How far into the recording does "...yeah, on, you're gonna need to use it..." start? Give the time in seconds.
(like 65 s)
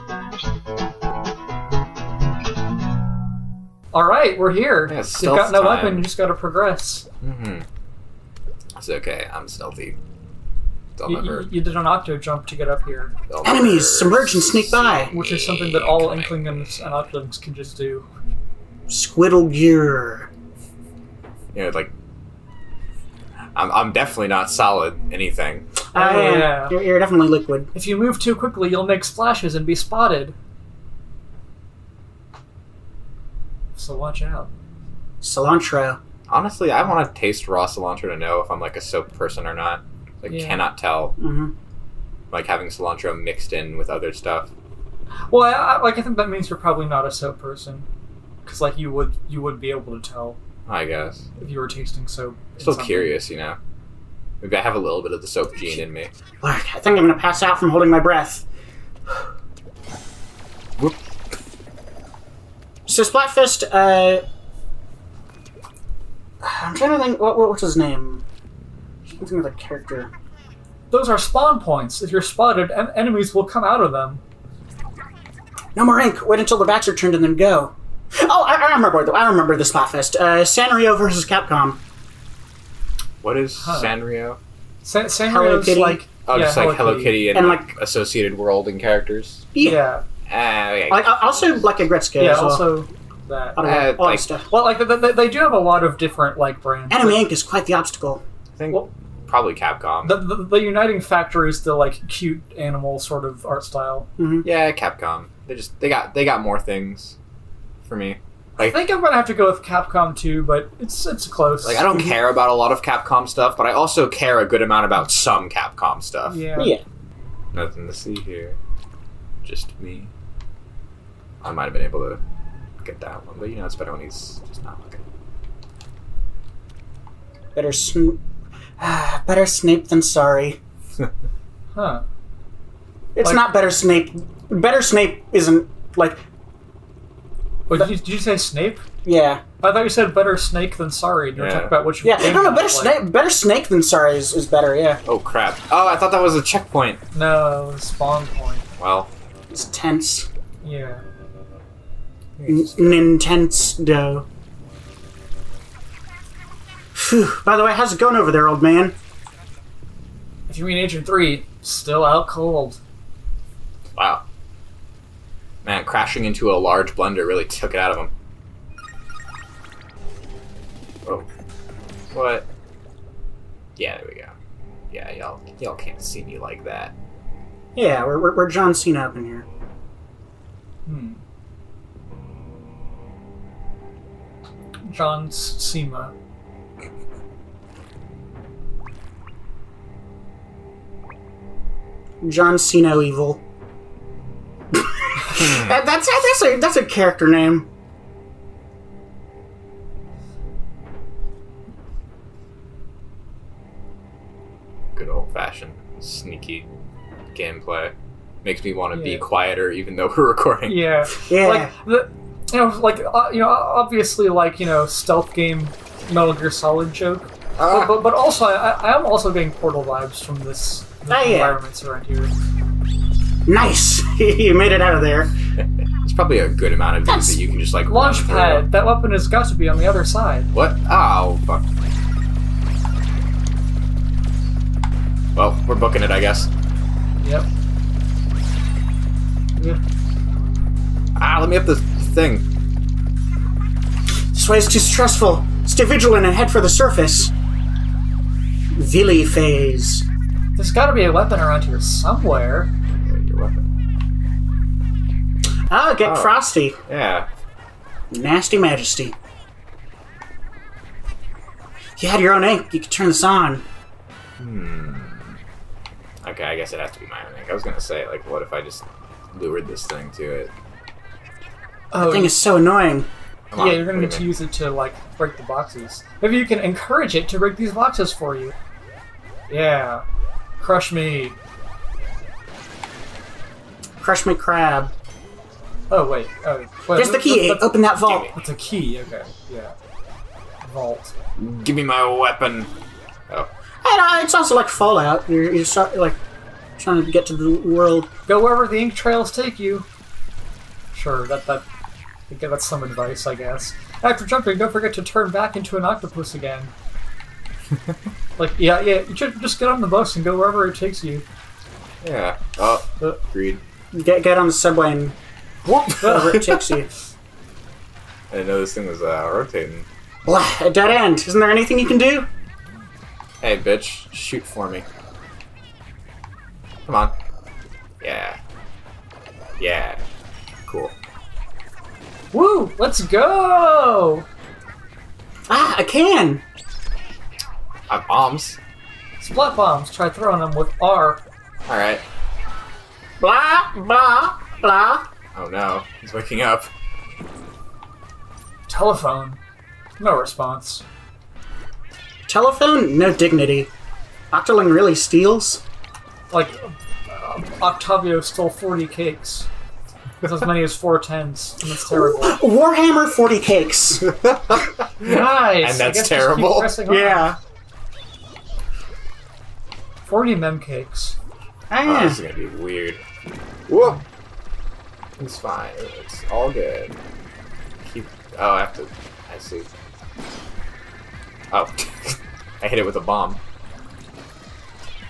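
273 s.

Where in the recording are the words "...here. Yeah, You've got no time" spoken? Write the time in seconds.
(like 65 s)
4 s.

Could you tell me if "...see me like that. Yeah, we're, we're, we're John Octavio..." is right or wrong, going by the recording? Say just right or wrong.
wrong.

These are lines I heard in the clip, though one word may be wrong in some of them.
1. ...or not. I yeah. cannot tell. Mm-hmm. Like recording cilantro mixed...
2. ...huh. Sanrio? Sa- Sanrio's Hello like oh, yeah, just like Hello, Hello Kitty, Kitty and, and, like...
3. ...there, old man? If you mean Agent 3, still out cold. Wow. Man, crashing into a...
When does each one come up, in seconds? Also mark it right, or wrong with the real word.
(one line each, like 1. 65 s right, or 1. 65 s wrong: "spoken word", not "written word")
1. 39 s wrong: "having", not "recording"
2. 83 s right
3. 158 s right.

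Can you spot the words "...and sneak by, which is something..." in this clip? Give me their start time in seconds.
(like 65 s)
14 s.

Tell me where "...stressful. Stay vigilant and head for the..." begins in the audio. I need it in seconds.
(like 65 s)
244 s.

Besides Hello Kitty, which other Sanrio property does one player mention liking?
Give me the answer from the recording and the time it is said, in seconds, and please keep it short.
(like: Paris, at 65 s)
Aggretsuko, at 91 s.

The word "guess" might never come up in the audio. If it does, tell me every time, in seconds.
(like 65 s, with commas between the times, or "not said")
50 s, 236 s, 266 s, 303 s.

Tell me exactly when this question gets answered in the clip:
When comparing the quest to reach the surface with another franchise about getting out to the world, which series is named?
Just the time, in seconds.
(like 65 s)
294 s.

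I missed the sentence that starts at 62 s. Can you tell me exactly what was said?
So Splatfest, uh, I'm trying to think, what, what was his name?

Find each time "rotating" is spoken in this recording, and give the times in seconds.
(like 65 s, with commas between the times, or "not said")
319 s.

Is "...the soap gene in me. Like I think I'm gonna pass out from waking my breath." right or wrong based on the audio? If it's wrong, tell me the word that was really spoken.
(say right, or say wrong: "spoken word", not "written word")
wrong: "holding", not "waking".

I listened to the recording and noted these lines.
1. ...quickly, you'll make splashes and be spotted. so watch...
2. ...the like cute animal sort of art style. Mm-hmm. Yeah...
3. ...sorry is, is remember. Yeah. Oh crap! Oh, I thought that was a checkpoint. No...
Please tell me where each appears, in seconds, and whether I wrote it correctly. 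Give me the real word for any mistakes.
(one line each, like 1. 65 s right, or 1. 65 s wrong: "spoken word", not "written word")
1. 28 s right
2. 101 s right
3. 143 s wrong: "better", not "remember".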